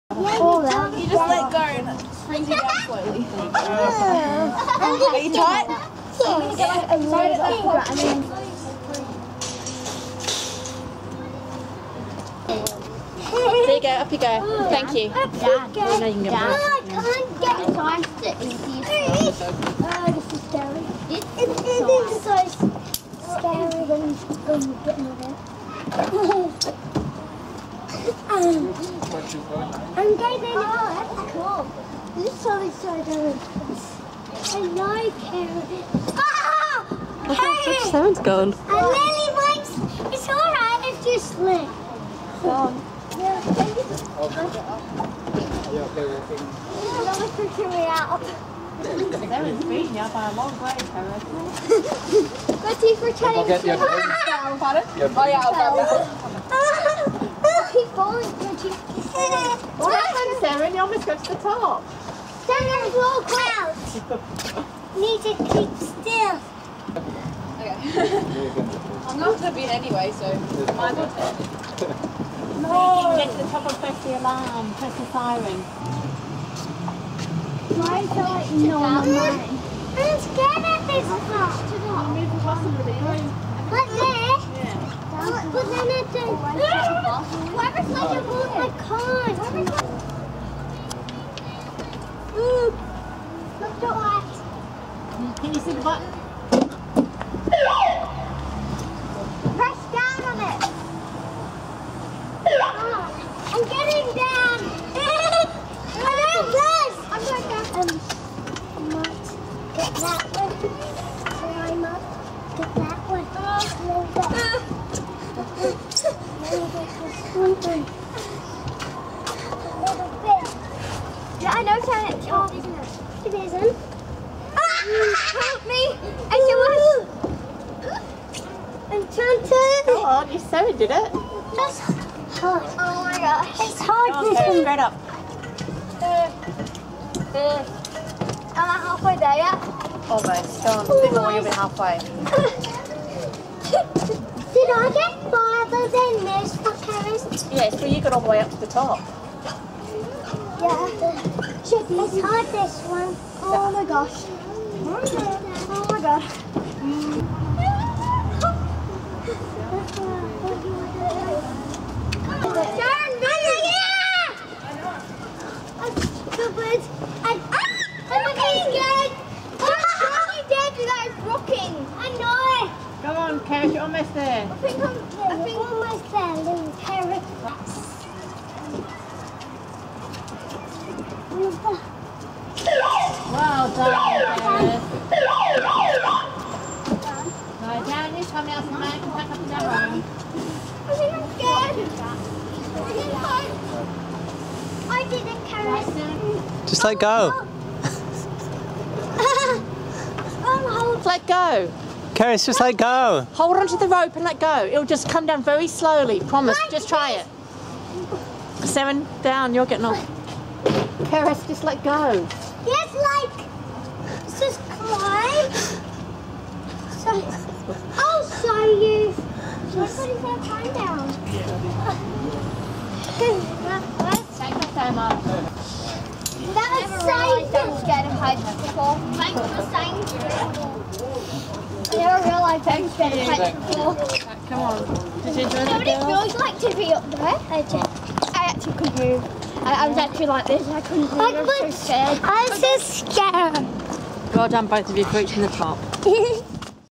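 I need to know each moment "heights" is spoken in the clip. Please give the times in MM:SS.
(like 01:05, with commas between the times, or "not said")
03:48, 03:53.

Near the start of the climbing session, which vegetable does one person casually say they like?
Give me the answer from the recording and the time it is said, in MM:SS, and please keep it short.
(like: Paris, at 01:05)
carrots, at 00:35.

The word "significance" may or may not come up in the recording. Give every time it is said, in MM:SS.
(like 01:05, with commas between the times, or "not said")
not said.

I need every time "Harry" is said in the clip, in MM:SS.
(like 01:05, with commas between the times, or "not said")
00:37, 00:50.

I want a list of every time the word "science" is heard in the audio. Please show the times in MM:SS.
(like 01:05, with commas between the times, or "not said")
03:49.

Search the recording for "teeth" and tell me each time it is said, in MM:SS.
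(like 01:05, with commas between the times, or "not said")
00:52, 00:58.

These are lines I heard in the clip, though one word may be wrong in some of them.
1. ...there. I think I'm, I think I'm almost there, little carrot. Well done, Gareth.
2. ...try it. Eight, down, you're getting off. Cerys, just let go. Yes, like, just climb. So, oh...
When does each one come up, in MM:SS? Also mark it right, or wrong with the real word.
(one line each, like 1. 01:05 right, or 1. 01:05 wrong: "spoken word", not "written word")
1. 02:54 right
2. 03:26 wrong: "Seven", not "Eight".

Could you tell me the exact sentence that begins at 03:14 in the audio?
I didn't I didn't carry Just let go.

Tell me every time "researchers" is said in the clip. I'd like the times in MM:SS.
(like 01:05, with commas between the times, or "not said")
not said.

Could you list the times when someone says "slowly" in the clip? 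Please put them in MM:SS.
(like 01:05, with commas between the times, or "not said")
00:02, 03:25.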